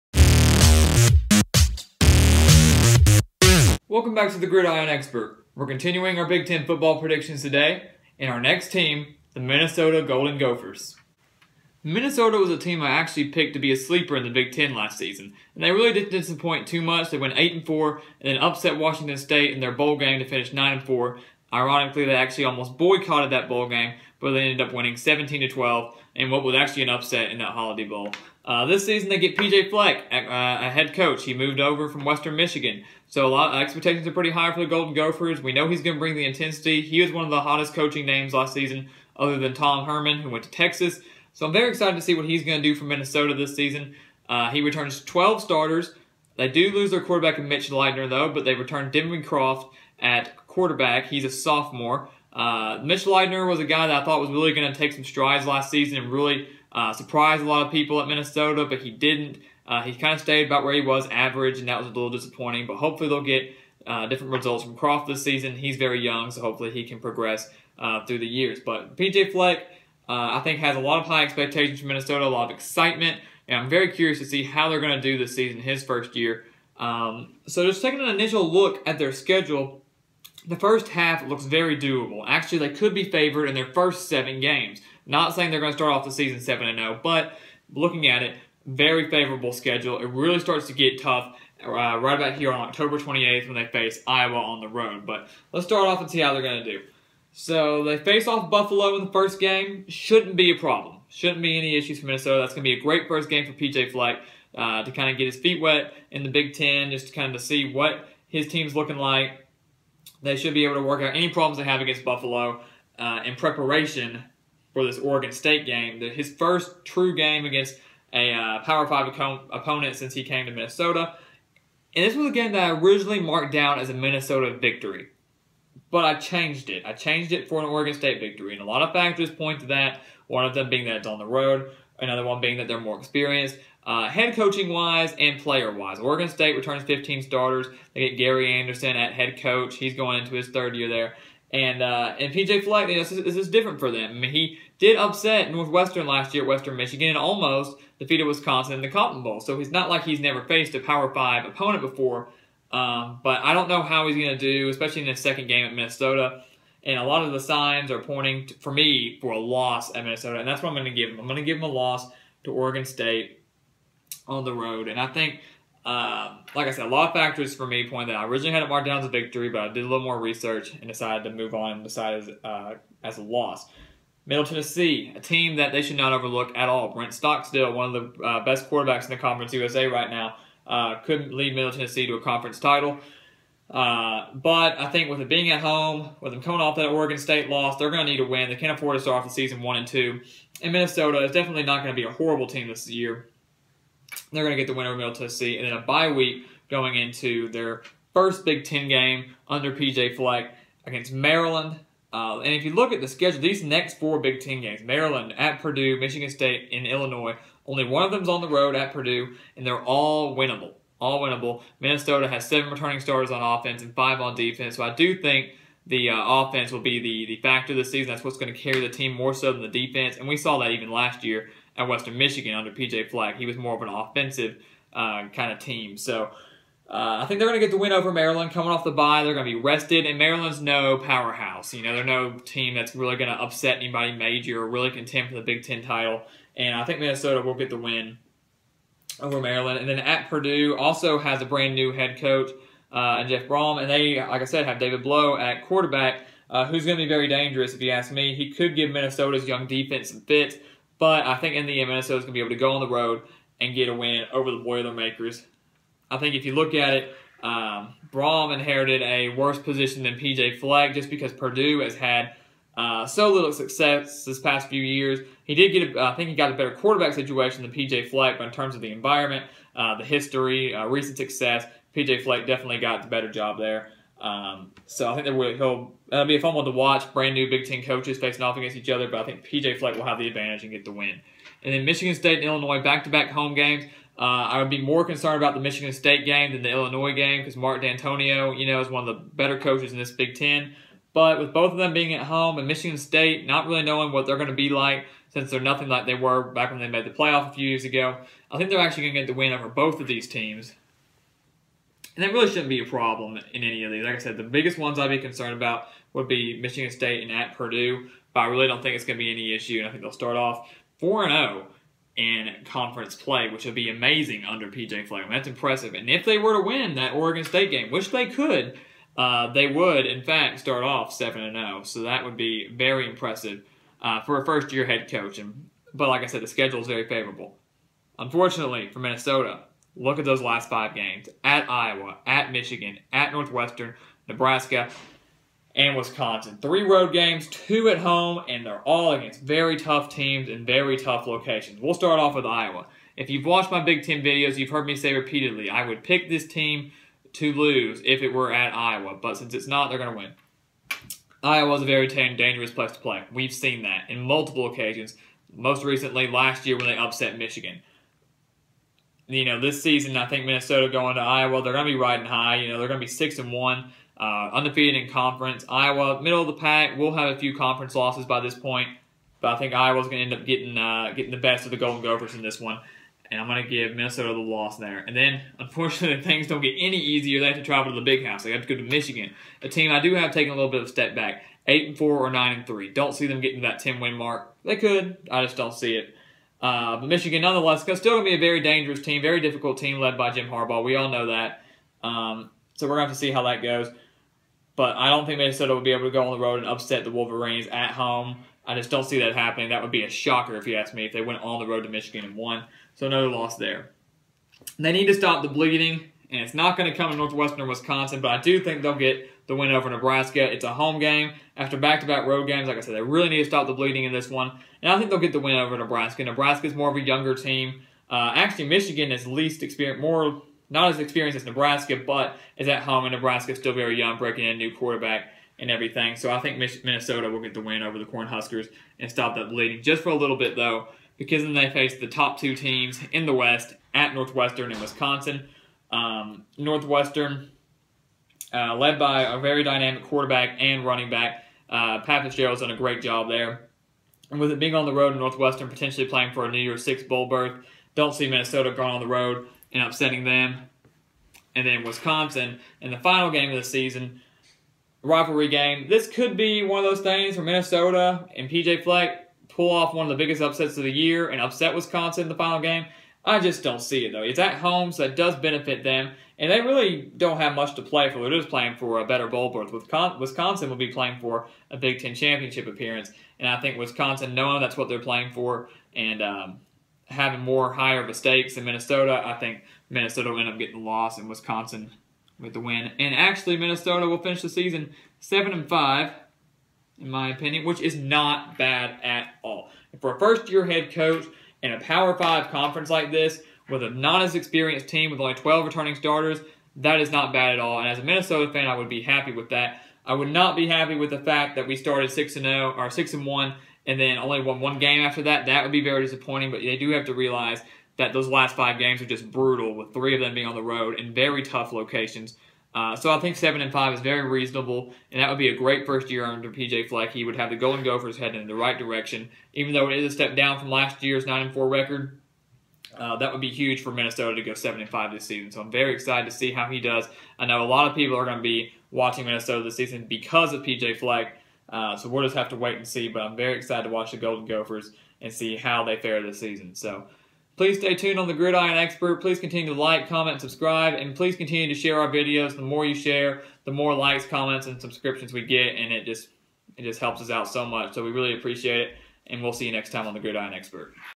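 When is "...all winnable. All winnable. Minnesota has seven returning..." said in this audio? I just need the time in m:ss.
3:29.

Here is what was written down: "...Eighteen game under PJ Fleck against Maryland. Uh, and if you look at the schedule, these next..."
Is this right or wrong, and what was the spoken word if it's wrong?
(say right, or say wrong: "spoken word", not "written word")
wrong: "Ten", not "Eighteen".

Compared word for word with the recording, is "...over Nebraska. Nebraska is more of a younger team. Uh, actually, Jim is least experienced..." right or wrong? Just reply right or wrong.
wrong.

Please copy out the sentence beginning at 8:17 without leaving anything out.
And as a Minnesota fan, I would be happy with that.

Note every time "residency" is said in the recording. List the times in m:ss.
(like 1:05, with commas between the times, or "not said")
not said.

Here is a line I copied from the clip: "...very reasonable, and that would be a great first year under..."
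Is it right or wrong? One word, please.
right.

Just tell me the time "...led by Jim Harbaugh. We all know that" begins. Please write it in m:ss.
6:29.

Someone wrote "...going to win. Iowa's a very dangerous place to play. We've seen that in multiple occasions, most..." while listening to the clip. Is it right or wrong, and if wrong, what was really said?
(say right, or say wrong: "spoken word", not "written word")
right.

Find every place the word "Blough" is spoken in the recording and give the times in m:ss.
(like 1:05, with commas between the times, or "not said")
4:05.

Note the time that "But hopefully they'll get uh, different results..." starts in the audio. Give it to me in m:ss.
1:02.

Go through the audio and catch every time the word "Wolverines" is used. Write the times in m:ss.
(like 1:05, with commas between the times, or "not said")
6:37.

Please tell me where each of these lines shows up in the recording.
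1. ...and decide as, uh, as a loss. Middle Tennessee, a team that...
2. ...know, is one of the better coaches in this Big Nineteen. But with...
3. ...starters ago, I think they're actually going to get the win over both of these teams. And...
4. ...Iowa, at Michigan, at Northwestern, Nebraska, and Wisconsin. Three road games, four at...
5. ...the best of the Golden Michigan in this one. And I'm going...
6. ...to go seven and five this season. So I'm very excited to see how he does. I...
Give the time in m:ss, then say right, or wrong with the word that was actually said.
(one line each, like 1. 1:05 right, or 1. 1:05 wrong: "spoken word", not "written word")
1. 2:51 right
2. 4:48 wrong: "Ten", not "Nineteen"
3. 4:57 wrong: "years", not "starters"
4. 5:31 wrong: "two", not "four"
5. 6:11 wrong: "Gophers", not "Michigan"
6. 8:44 right.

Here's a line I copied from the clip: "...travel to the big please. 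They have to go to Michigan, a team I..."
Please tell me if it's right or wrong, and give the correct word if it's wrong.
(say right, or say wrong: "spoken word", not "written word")
wrong: "house", not "please".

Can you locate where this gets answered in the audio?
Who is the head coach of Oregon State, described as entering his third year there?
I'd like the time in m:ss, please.
2:18.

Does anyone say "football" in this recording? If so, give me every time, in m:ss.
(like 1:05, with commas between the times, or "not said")
0:06.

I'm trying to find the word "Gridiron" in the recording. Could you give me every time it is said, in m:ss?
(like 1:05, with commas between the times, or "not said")
0:04, 8:58, 9:10.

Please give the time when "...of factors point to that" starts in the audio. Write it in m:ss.
2:08.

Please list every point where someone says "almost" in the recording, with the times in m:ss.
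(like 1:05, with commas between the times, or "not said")
0:22, 2:27.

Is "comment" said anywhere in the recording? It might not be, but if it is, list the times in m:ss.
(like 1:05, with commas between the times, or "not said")
9:00, 9:04.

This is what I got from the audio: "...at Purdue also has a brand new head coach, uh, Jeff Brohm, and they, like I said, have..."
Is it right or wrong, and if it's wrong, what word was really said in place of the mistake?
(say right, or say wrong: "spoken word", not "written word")
right.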